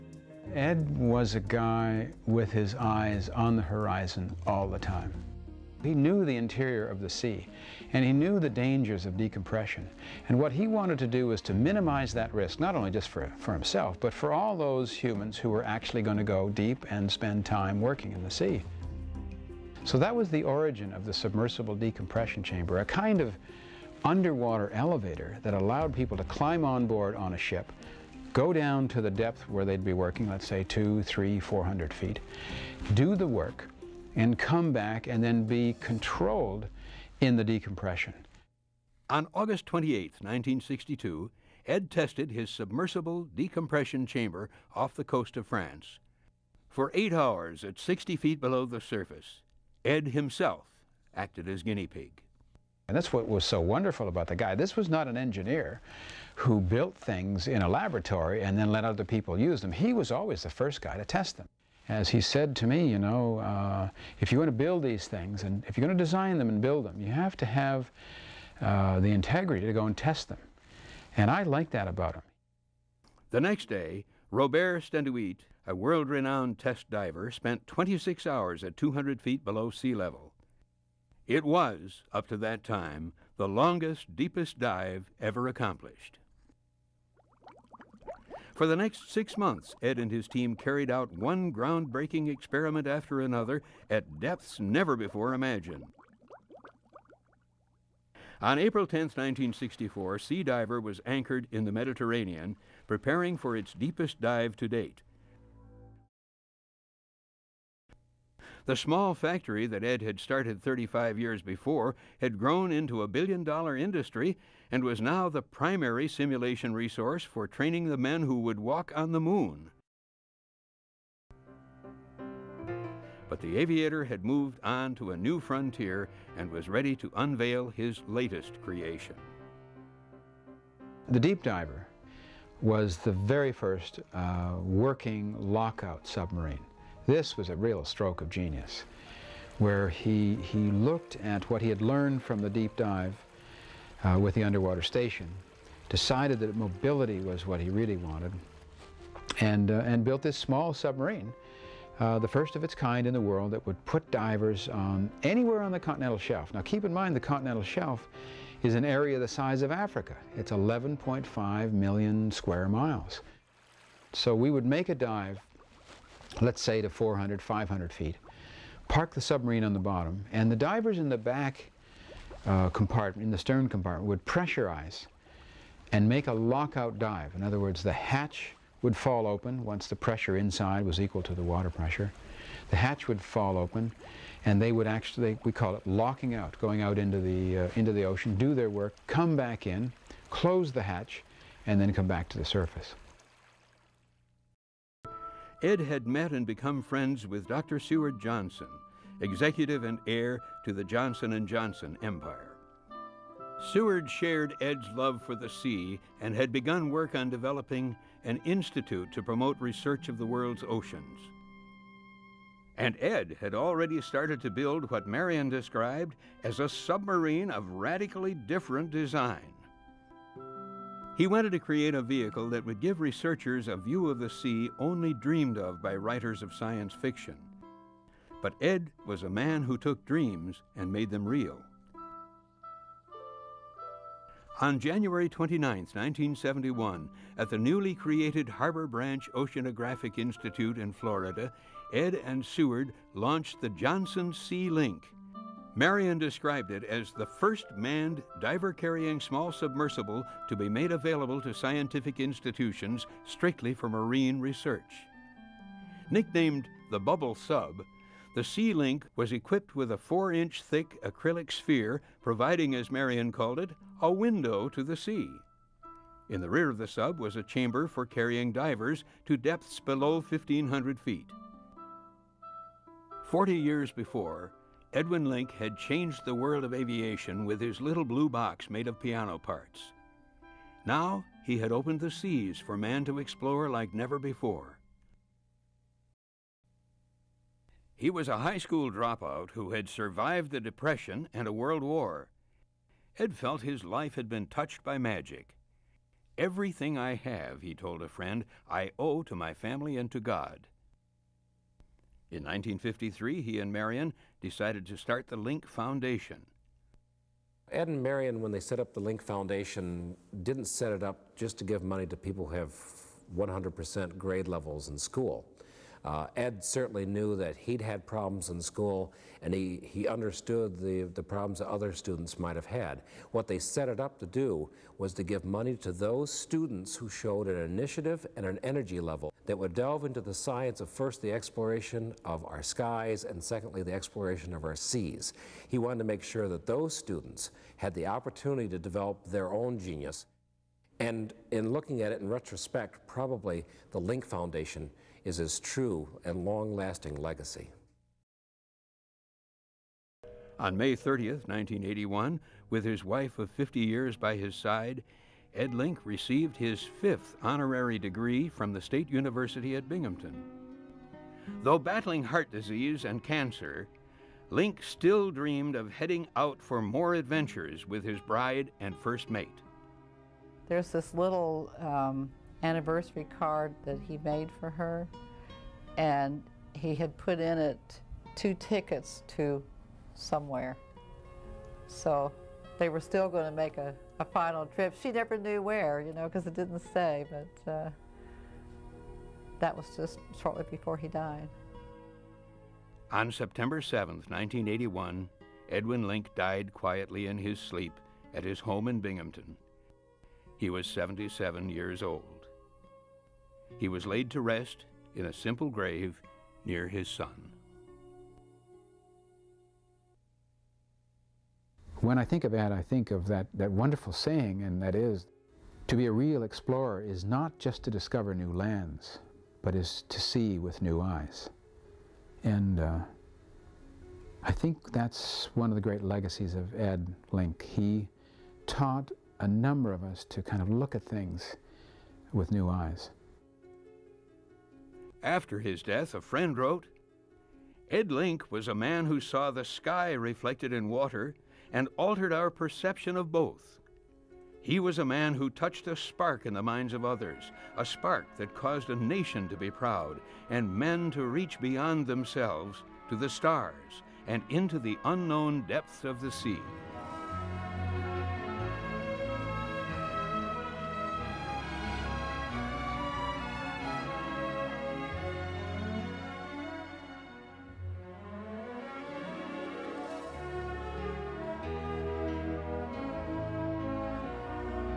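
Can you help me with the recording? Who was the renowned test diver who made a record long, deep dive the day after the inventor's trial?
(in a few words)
Robert Sténuit.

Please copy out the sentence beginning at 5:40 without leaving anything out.
And in looking at it in retrospect, probably the Link Foundation is his true and long-lasting legacy.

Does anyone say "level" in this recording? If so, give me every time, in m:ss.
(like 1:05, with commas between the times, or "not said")
1:19, 5:14, 5:28.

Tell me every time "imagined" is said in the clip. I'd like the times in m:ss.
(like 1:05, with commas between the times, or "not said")
1:35.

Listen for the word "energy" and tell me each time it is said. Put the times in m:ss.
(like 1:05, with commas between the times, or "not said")
5:28.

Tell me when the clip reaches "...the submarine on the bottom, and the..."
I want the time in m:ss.
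2:49.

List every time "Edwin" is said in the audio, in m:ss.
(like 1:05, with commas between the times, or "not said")
4:34, 6:35.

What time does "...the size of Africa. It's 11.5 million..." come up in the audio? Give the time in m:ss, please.
2:39.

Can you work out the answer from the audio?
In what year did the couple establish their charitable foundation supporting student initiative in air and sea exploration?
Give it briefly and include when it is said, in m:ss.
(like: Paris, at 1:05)
1953, at 5:02.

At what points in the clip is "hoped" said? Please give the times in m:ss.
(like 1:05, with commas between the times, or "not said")
not said.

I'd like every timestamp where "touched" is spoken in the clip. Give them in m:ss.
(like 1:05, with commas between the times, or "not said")
4:54, 7:25.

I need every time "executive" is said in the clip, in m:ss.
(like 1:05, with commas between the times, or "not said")
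3:19.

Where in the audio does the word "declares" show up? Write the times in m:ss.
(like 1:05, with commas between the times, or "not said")
not said.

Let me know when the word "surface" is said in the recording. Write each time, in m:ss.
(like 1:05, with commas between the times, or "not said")
0:48, 3:12.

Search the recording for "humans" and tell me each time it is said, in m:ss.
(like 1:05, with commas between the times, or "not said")
0:14.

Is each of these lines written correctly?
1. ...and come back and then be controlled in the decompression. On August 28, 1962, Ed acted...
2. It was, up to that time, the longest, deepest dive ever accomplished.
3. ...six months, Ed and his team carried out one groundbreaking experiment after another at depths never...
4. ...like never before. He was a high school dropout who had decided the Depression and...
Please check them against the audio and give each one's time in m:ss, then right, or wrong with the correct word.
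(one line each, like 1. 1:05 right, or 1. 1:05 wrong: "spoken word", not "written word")
1. 0:34 wrong: "tested", not "acted"
2. 1:21 right
3. 1:29 right
4. 4:43 wrong: "survived", not "decided".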